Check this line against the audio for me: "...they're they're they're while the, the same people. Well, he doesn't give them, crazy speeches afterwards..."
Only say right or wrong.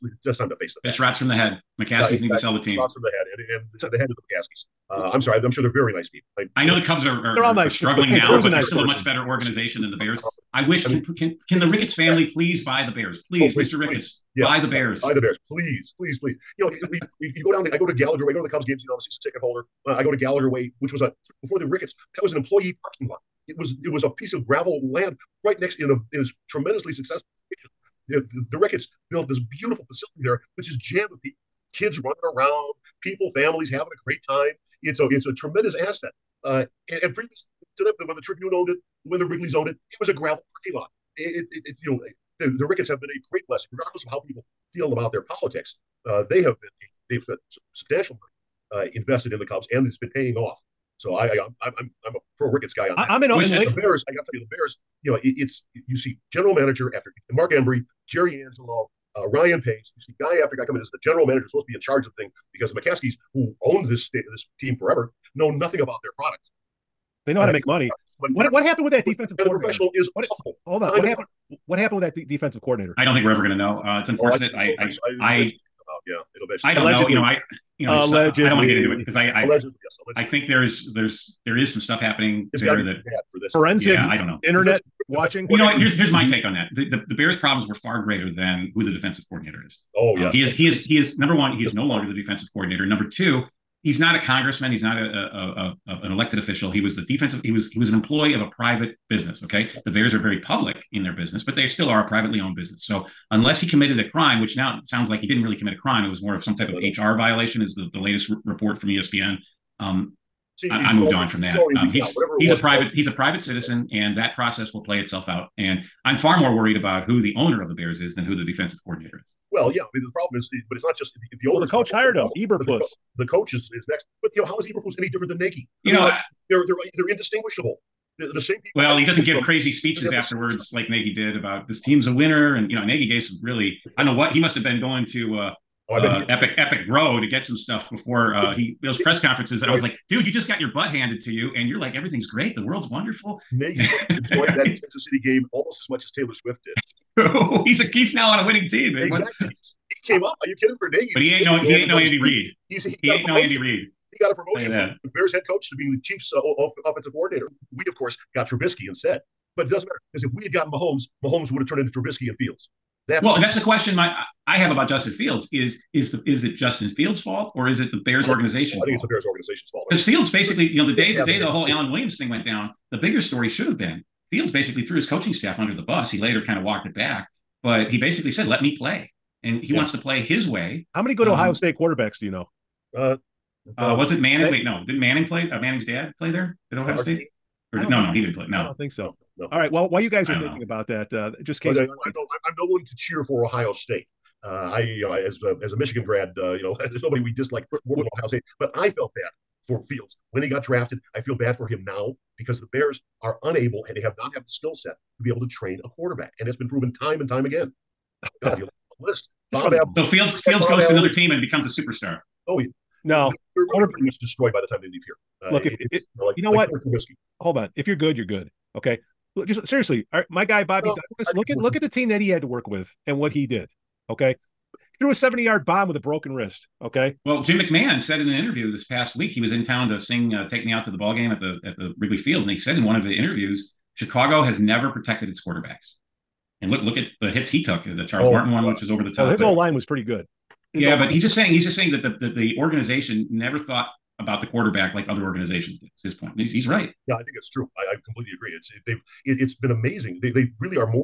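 wrong.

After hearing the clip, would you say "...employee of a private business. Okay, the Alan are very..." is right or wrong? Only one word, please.
wrong.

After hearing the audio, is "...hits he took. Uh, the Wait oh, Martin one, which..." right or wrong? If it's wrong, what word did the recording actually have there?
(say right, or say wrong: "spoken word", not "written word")
wrong: "Charles", not "Wait".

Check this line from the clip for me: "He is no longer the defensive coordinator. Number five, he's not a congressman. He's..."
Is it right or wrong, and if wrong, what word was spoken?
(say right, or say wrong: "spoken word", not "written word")
wrong: "two", not "five".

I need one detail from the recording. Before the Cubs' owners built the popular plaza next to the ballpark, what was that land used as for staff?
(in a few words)
Employee parking lot.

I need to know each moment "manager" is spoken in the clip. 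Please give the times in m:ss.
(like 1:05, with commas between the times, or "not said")
0:56, 1:01.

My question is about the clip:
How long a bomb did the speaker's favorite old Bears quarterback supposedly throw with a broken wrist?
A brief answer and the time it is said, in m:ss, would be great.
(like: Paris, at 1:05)
70 yards, at 3:45.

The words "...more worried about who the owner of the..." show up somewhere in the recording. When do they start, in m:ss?
1:56.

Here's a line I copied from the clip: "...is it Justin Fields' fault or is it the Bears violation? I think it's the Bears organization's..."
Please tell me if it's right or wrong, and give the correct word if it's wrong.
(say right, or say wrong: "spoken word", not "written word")
wrong: "organization", not "violation".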